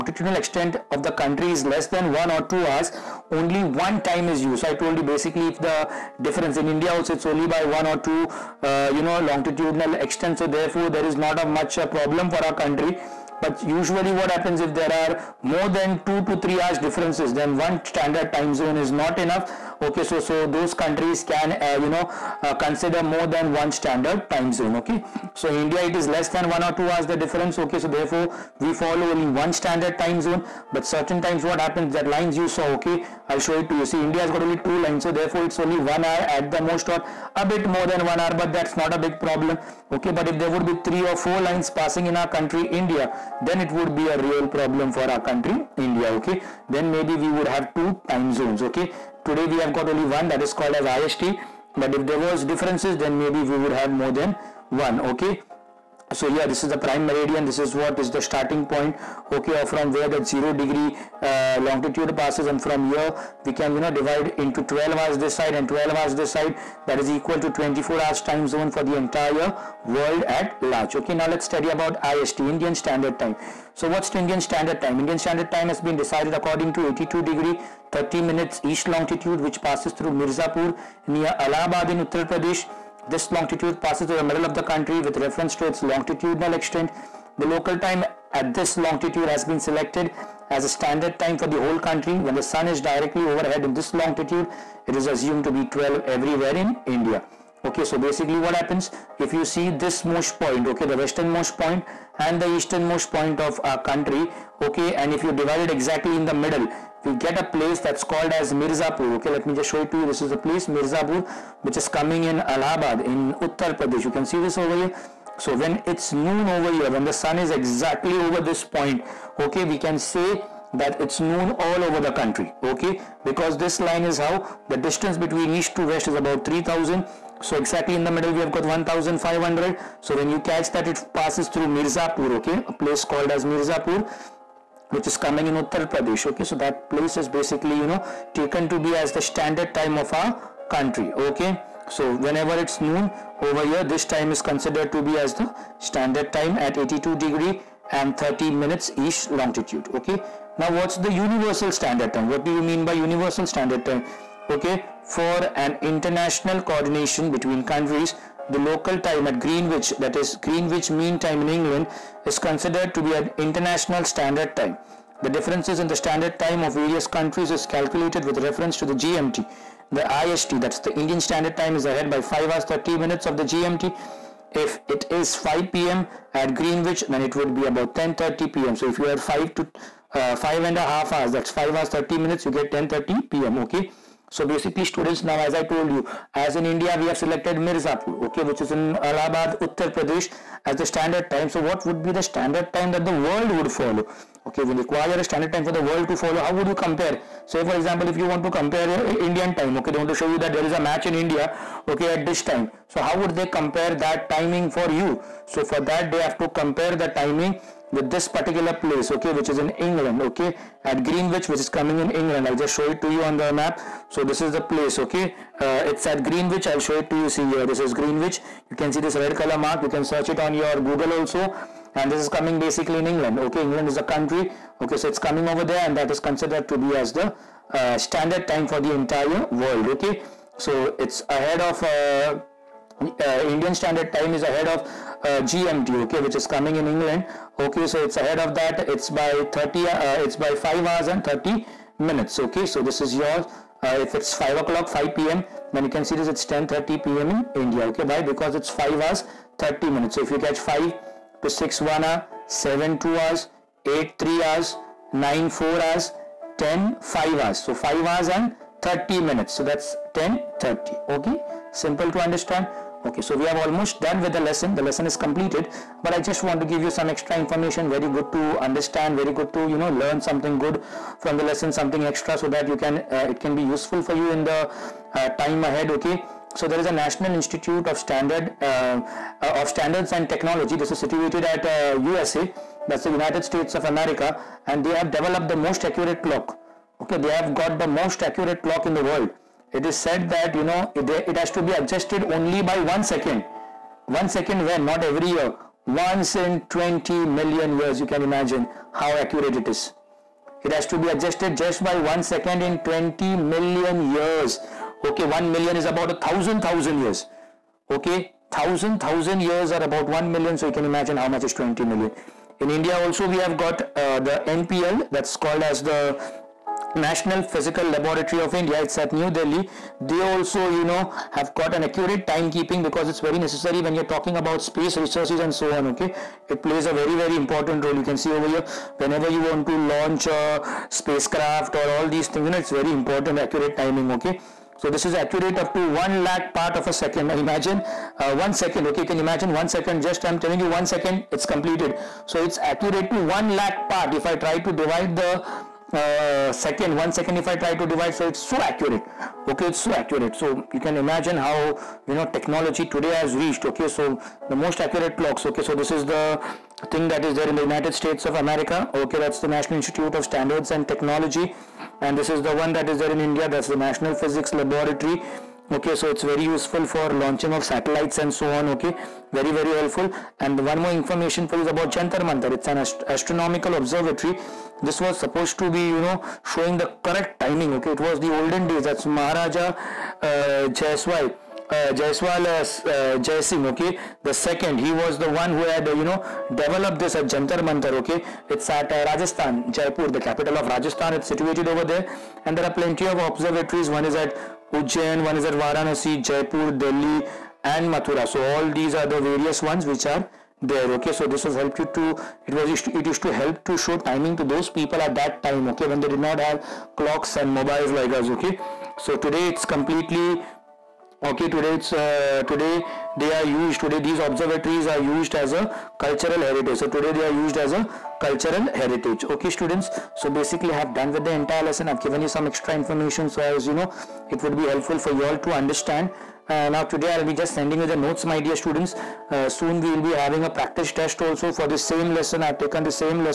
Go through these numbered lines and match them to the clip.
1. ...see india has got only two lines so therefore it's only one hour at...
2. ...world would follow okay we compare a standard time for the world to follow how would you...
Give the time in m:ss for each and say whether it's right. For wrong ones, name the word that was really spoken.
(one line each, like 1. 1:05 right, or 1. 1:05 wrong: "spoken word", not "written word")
1. 0:33 right
2. 3:13 wrong: "require", not "compare".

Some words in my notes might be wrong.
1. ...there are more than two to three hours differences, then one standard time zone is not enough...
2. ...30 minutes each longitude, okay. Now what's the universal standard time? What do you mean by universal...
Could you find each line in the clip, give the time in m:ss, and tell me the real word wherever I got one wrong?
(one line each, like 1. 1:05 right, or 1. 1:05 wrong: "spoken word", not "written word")
1. 0:14 right
2. 2:28 right.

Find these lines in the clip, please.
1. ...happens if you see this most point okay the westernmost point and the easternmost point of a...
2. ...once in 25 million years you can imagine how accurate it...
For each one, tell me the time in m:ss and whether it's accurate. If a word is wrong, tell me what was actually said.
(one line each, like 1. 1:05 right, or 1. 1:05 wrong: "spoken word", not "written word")
1. 1:38 right
2. 4:55 wrong: "20", not "25".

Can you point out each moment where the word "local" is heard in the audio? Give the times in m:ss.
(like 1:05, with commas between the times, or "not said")
1:27, 2:38.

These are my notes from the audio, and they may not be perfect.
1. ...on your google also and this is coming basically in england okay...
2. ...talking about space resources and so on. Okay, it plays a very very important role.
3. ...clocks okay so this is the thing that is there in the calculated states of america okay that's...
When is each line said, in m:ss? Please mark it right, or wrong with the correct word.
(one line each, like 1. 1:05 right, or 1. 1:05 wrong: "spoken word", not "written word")
1. 3:40 right
2. 5:24 right
3. 5:55 wrong: "united", not "calculated".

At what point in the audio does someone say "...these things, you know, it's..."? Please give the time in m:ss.
5:32.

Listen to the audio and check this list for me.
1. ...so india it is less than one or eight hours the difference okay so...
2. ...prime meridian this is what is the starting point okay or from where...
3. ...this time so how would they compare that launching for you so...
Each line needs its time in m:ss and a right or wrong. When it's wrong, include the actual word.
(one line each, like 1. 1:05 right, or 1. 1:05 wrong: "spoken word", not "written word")
1. 0:25 wrong: "two", not "eight"
2. 0:56 right
3. 3:22 wrong: "timing", not "launching".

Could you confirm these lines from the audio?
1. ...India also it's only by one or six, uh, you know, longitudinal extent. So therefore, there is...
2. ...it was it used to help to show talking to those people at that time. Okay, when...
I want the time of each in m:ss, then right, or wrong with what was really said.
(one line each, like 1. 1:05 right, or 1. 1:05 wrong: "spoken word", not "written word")
1. 0:06 wrong: "two", not "six"
2. 6:42 wrong: "timing", not "talking".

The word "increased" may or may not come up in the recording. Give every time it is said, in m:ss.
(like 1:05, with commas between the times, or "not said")
not said.